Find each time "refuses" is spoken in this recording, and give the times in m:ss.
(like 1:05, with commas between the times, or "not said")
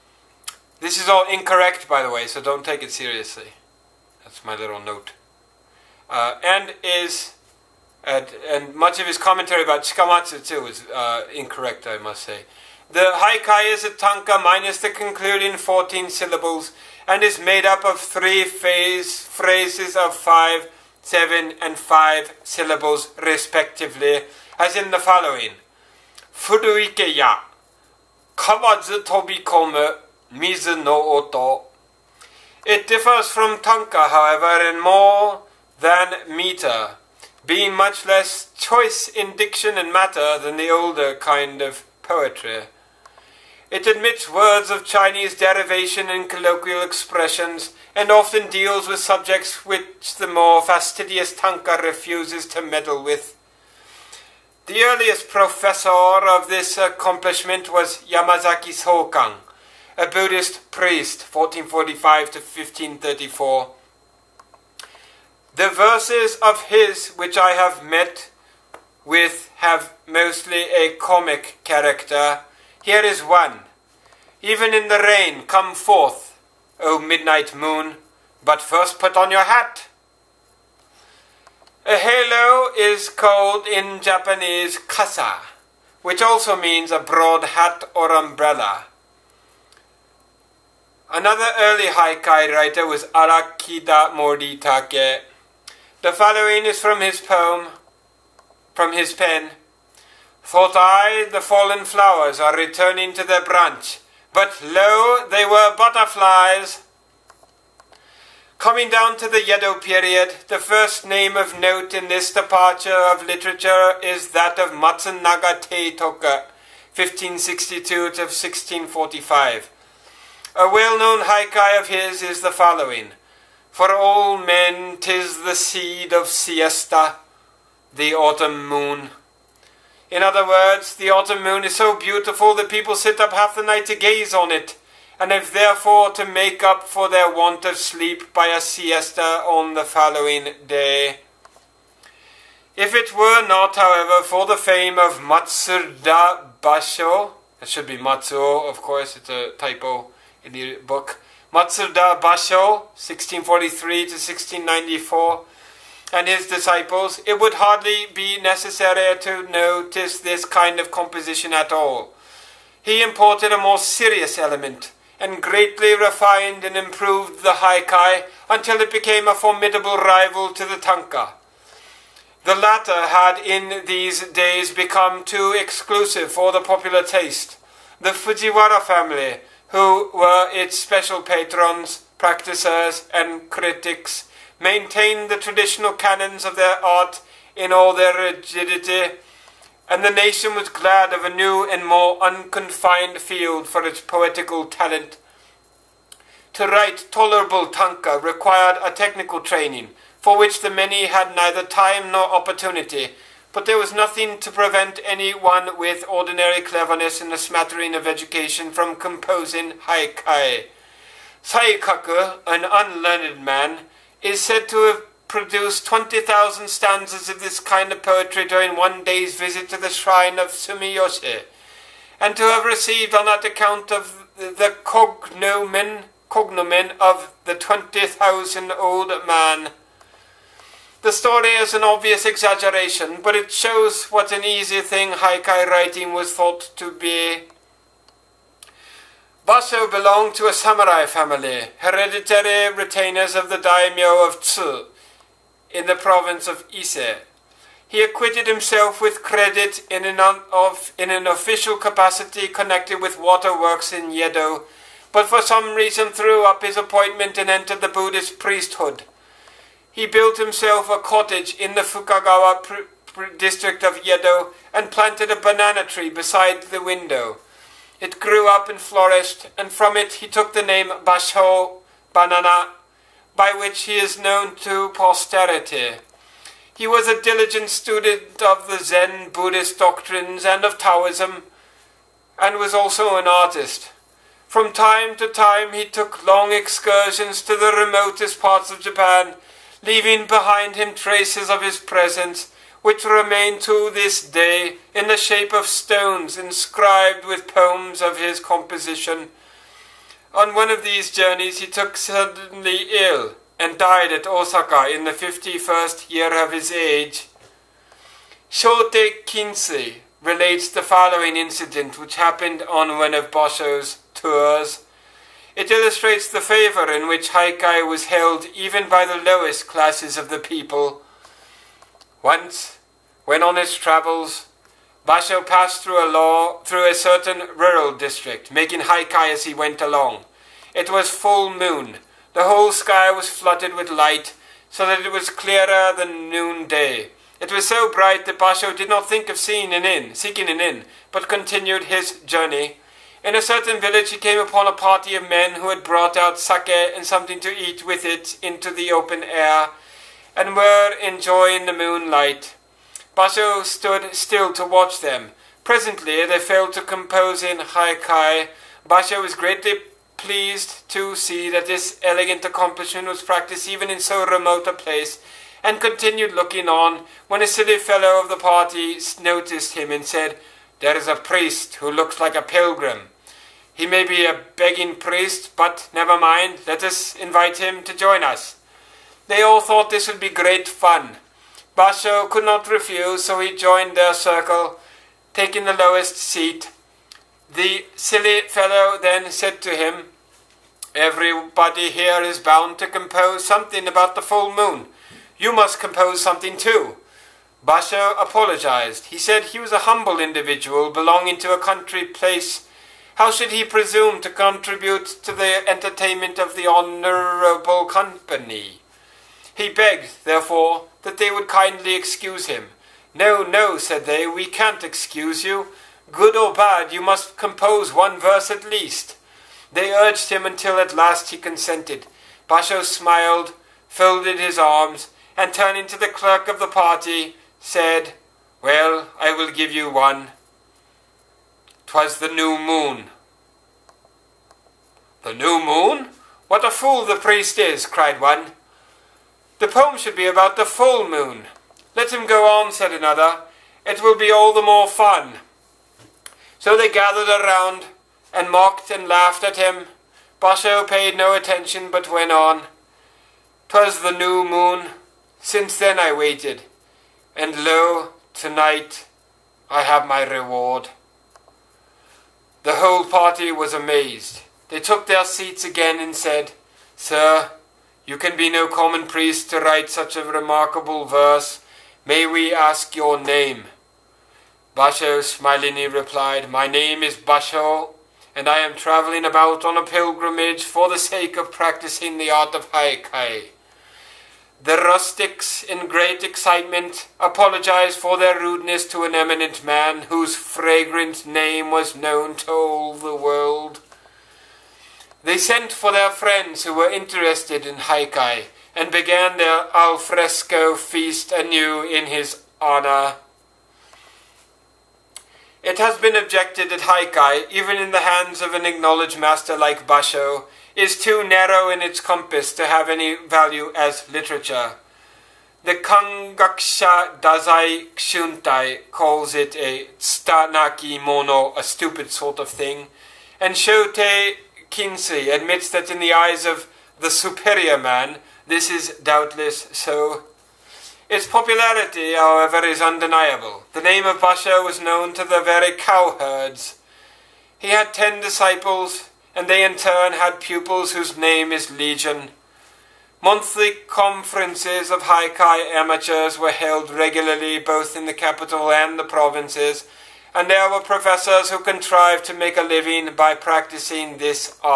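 0:51, 6:22.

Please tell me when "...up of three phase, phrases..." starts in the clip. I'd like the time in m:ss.
0:17.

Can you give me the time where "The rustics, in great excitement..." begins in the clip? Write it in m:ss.
8:04.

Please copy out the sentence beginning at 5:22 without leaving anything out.
Once, when on his travels, Basho passed through a, law, through a certain rural district, making haikai as he went along.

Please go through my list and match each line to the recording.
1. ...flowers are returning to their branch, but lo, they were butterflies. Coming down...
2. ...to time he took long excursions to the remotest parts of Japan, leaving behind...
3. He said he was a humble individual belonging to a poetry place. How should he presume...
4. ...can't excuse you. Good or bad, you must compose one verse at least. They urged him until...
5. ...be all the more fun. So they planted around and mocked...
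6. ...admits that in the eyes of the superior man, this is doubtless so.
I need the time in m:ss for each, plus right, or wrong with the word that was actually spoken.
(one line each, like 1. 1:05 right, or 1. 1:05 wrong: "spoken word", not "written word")
1. 1:41 right
2. 4:45 right
3. 6:39 wrong: "country", not "poetry"
4. 6:54 right
5. 7:24 wrong: "gathered", not "planted"
6. 8:45 right.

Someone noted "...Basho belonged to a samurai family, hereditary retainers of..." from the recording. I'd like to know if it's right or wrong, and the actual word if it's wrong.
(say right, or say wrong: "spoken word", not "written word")
right.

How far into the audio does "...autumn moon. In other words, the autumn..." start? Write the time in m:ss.
2:08.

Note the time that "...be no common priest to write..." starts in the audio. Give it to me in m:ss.
7:48.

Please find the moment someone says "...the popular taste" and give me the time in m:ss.
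2:56.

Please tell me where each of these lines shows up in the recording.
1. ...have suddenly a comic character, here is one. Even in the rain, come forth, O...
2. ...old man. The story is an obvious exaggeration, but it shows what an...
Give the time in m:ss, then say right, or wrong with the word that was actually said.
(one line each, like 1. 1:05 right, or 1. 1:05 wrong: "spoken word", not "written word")
1. 1:09 wrong: "mostly", not "suddenly"
2. 3:48 right.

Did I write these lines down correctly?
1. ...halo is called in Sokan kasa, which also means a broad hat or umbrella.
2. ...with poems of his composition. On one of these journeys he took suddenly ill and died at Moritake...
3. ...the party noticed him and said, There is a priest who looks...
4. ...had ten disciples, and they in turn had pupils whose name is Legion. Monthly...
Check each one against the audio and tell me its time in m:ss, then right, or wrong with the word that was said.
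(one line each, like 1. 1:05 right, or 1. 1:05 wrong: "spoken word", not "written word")
1. 1:21 wrong: "Japanese", not "Sokan"
2. 4:57 wrong: "Osaka", not "Moritake"
3. 6:08 right
4. 8:57 right.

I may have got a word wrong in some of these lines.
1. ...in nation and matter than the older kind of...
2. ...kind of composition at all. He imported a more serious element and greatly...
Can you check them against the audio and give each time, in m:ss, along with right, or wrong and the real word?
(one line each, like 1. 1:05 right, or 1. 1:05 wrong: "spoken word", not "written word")
1. 0:39 wrong: "diction", not "nation"
2. 2:40 right.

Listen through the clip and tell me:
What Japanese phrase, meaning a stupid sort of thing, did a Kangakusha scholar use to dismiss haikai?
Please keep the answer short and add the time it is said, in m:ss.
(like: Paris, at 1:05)
tsutanaki mono, at 8:39.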